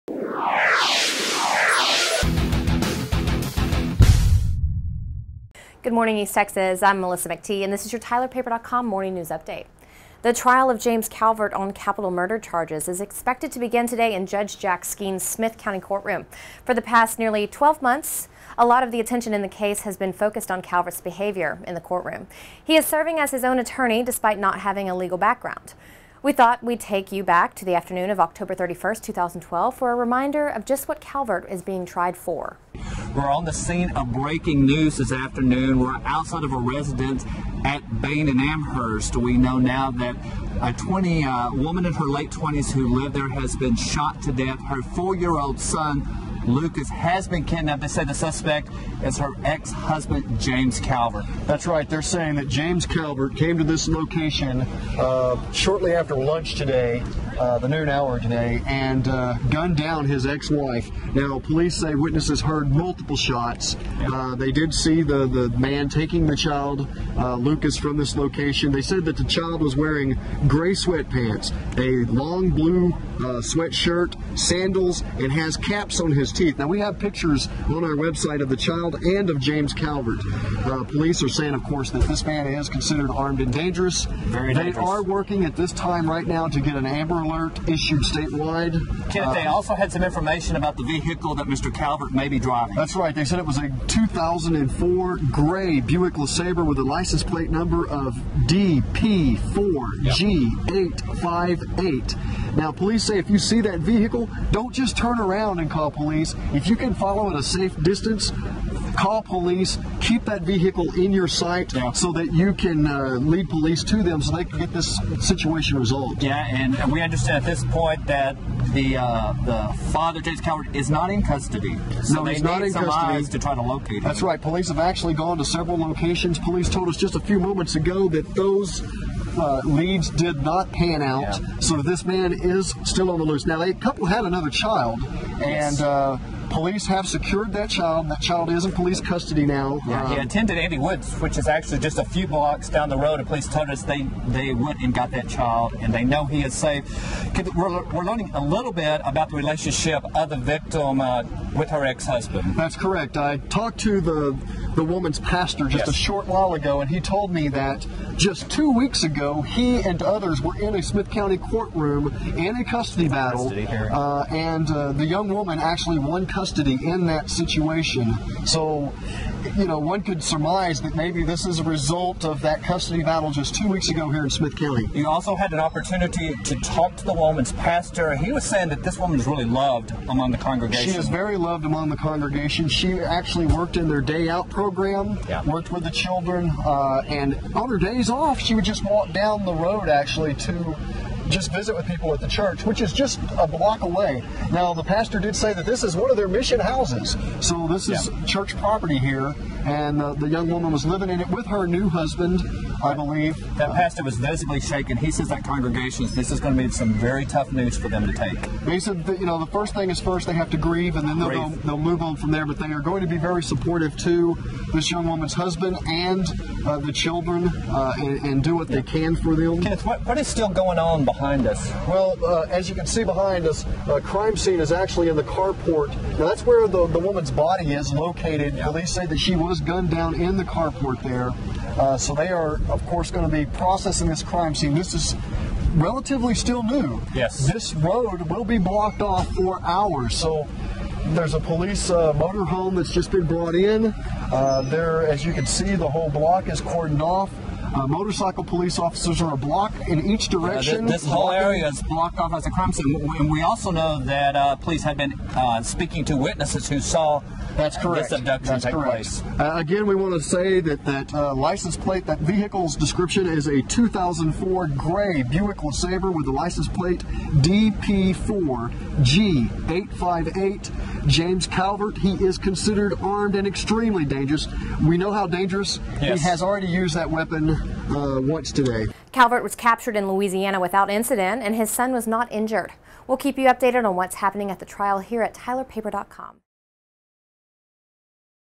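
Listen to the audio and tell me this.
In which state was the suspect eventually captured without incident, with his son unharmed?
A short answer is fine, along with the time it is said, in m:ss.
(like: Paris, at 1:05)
Louisiana, at 4:40.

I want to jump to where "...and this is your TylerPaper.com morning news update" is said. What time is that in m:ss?
0:07.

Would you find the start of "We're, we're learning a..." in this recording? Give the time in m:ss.
2:27.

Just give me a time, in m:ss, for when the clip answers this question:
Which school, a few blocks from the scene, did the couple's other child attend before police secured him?
2:20.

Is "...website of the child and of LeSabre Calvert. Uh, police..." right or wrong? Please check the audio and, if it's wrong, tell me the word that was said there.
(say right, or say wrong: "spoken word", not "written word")
wrong: "James", not "LeSabre".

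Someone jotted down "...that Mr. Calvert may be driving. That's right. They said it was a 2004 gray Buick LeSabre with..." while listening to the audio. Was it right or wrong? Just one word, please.
right.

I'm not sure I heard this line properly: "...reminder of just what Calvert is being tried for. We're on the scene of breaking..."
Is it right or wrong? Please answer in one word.
right.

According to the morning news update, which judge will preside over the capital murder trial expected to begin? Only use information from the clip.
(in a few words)
Jack Skeen.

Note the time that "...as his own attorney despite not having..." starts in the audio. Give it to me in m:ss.
0:23.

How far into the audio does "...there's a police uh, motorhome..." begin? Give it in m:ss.
4:01.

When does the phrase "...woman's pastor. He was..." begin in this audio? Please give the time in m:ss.
2:57.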